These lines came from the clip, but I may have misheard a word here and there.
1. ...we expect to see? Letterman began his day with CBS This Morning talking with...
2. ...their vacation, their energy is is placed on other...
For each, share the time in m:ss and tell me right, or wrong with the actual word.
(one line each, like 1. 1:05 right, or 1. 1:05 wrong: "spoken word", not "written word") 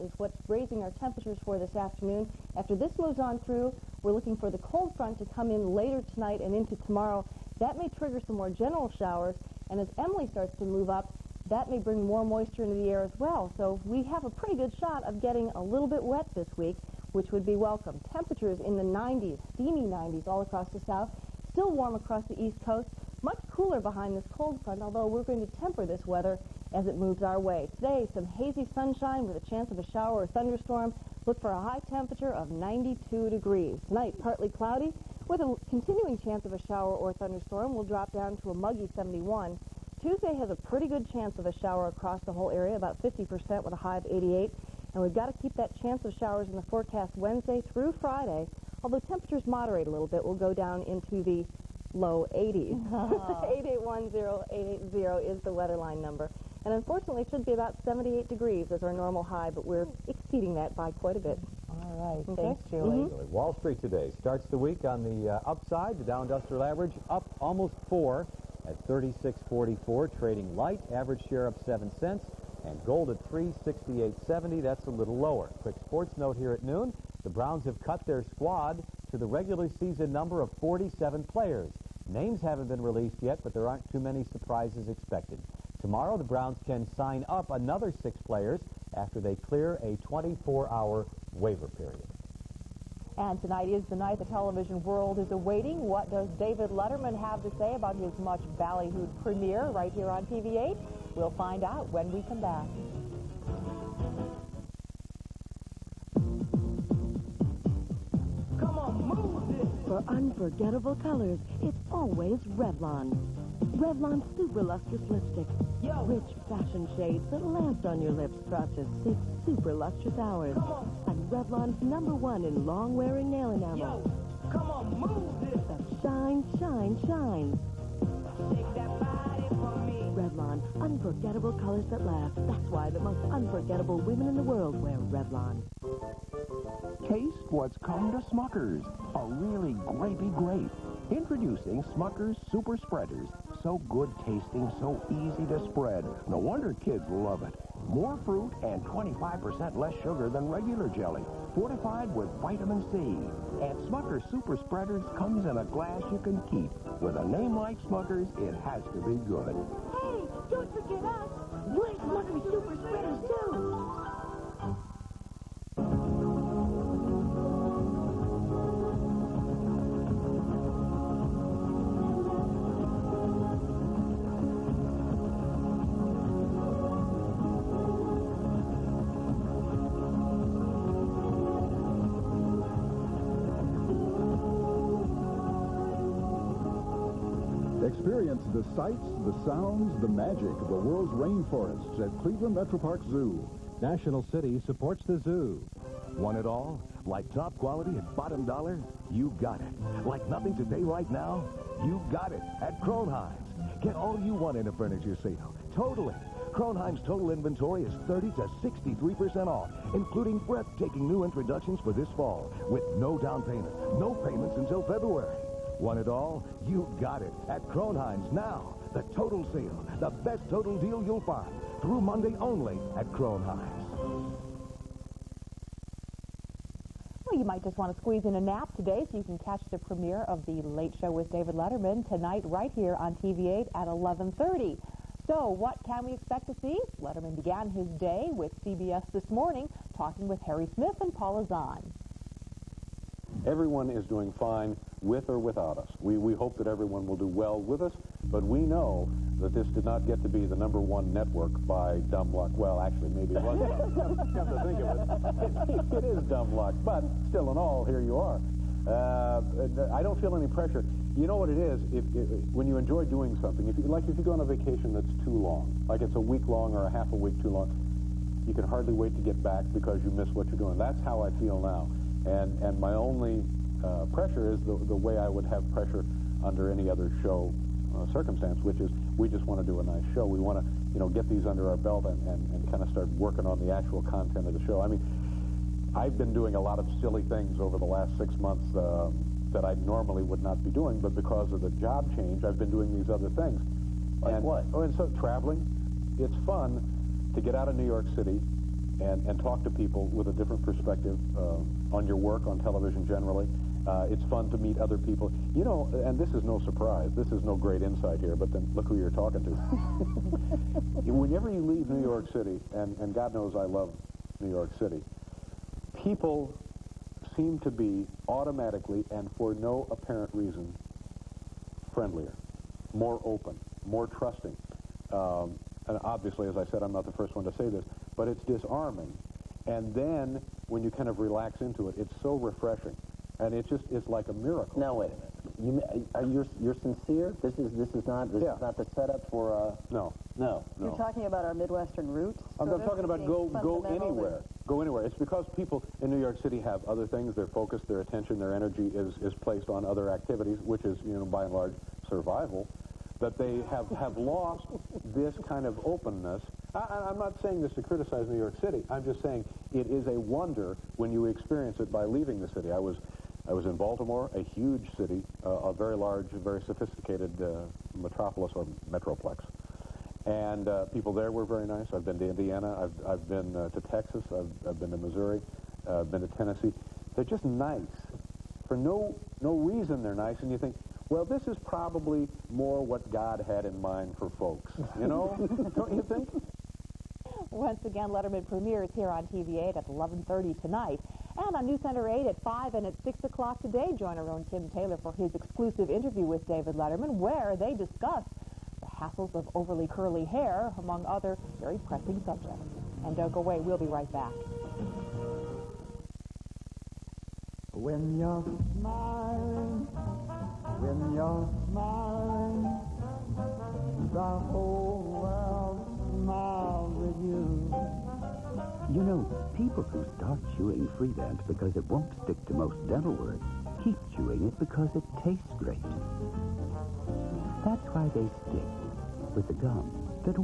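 1. 3:56 right
2. 5:47 wrong: "attention", not "vacation".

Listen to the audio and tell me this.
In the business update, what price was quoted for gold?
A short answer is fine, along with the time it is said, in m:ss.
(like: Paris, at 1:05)
368.70, at 1:13.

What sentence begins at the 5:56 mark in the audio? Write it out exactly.
I, I'm not saying this to criticize New York City.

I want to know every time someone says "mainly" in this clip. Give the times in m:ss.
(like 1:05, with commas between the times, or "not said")
not said.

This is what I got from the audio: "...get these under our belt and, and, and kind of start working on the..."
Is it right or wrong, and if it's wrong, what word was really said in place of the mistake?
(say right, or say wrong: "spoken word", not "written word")
right.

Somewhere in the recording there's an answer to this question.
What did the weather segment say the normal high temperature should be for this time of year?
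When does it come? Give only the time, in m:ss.
0:57.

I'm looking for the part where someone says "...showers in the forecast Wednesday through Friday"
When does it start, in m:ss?
0:46.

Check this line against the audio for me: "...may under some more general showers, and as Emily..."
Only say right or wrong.
wrong.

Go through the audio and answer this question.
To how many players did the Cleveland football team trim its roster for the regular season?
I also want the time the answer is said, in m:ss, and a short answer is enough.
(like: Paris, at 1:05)
47, at 1:20.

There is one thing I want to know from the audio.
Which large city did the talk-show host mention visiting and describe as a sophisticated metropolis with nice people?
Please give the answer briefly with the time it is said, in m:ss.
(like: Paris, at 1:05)
Baltimore, at 6:03.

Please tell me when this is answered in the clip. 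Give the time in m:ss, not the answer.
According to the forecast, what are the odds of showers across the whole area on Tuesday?
0:42.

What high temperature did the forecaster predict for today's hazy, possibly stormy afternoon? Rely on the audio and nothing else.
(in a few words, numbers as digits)
92 degrees.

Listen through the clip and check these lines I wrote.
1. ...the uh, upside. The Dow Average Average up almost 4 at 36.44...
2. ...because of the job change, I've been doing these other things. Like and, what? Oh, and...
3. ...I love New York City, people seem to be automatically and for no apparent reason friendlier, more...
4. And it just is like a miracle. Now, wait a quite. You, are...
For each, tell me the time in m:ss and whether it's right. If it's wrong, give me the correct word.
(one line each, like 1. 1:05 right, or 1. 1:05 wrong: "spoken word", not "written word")
1. 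1:05 wrong: "Industrial", not "Average"
2. 4:51 right
3. 5:13 right
4. 5:33 wrong: "minute", not "quite".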